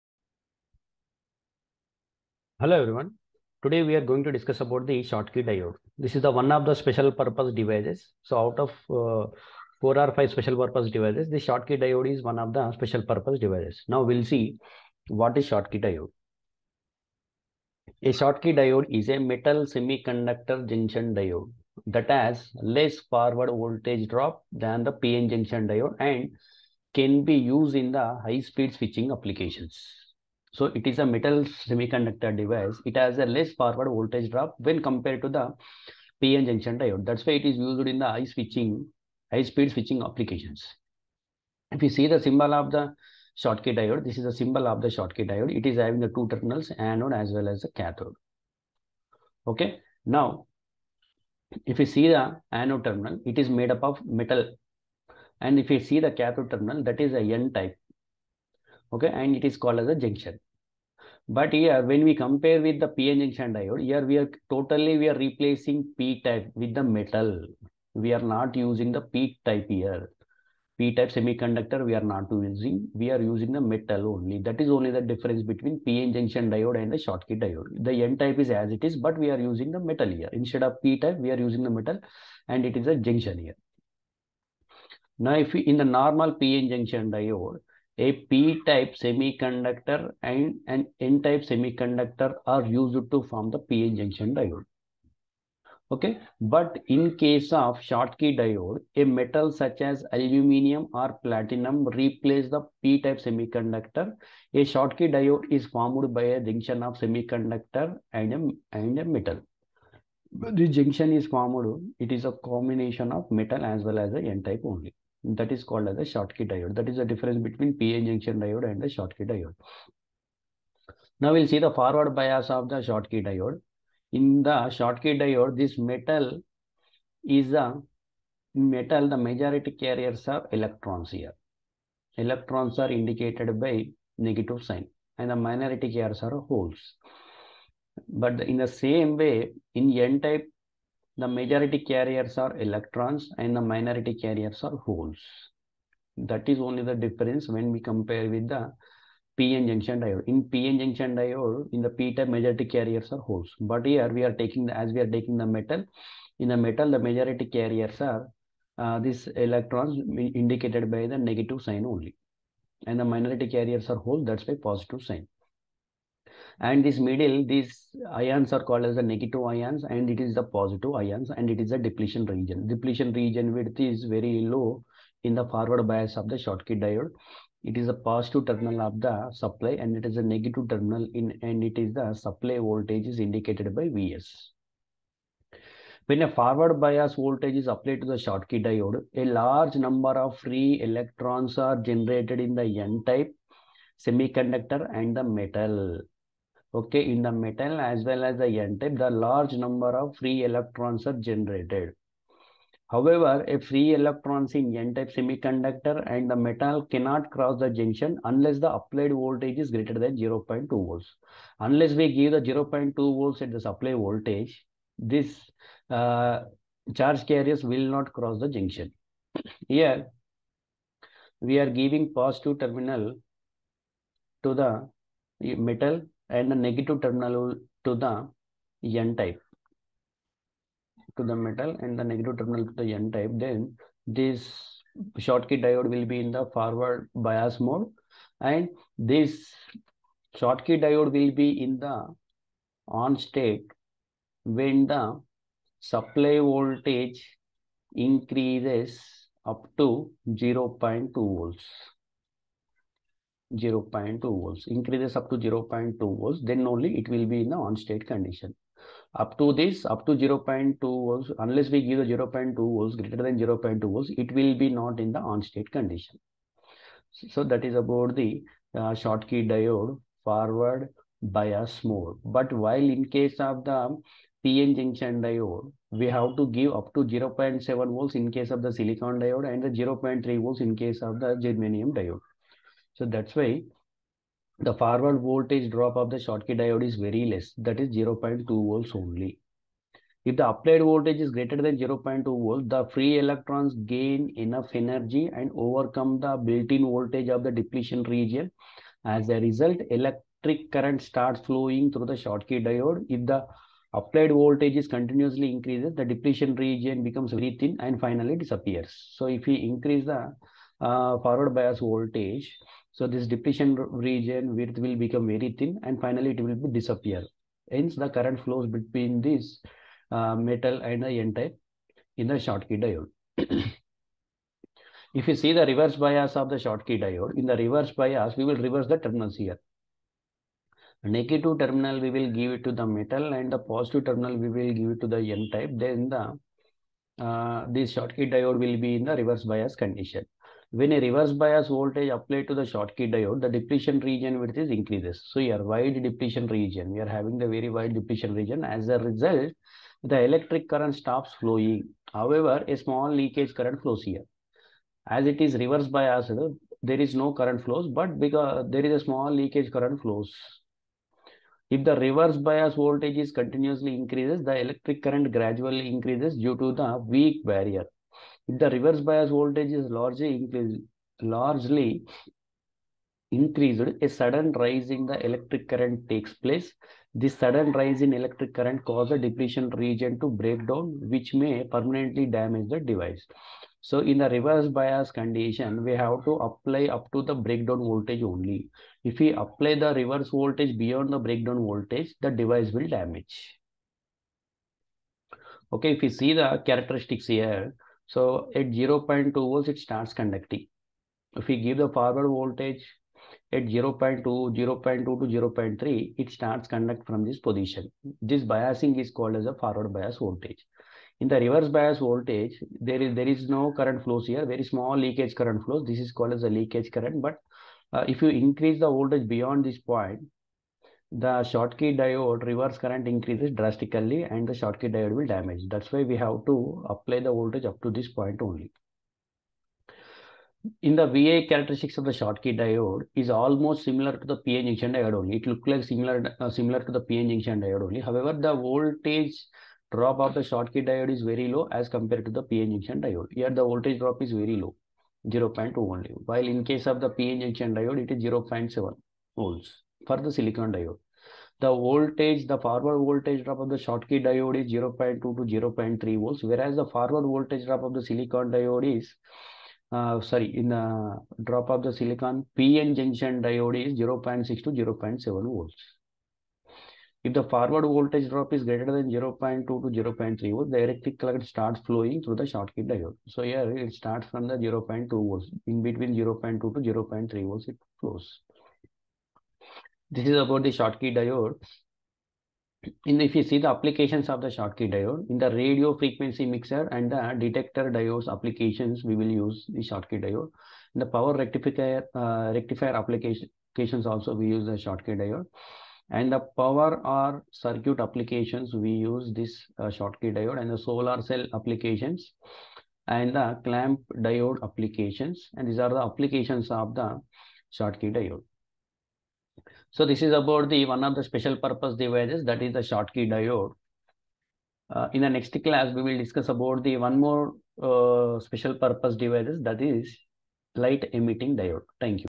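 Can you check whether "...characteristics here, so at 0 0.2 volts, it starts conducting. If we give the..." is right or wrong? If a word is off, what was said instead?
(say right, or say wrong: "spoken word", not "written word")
right.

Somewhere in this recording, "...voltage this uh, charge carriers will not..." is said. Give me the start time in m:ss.
3:34.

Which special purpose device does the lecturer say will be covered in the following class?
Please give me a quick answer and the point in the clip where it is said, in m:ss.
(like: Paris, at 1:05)
light emitting diode, at 8:40.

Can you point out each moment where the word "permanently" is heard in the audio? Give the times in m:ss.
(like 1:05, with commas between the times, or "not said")
6:21.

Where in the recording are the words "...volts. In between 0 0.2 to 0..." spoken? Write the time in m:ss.
7:55.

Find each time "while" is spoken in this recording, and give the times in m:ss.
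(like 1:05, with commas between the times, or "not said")
4:32, 7:26.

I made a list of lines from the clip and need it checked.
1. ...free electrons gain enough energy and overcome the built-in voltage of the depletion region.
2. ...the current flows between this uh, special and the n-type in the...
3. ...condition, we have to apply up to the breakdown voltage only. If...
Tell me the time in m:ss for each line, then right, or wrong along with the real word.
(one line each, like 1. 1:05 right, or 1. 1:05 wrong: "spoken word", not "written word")
1. 4:52 right
2. 5:17 wrong: "metal", not "special"
3. 6:25 right.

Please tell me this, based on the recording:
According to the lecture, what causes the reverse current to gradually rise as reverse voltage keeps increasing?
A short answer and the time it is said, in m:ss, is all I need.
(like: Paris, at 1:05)
weak barrier, at 6:06.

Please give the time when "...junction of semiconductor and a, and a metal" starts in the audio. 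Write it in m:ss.
1:46.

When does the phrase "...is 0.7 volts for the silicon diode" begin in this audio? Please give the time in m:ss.
7:28.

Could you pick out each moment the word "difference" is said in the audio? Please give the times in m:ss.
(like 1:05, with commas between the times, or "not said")
1:15, 1:57, 2:26.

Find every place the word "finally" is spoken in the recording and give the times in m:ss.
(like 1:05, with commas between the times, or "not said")
5:07, 5:15.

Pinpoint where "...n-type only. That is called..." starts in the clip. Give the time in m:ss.
1:54.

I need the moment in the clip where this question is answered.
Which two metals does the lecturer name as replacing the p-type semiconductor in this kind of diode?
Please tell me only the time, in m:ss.
1:40.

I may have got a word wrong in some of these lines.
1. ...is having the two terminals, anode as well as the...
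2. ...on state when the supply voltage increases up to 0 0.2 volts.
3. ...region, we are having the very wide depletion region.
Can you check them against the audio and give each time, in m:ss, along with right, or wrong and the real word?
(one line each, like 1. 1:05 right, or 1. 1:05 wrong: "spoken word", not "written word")
1. 0:45 right
2. 4:03 right
3. 5:46 right.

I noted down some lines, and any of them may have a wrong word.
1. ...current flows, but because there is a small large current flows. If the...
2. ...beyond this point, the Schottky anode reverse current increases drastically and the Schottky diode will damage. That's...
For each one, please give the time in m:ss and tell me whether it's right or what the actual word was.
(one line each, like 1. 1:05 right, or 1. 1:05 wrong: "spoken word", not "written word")
1. 5:57 wrong: "leakage", not "large"
2. 6:59 wrong: "diode", not "anode".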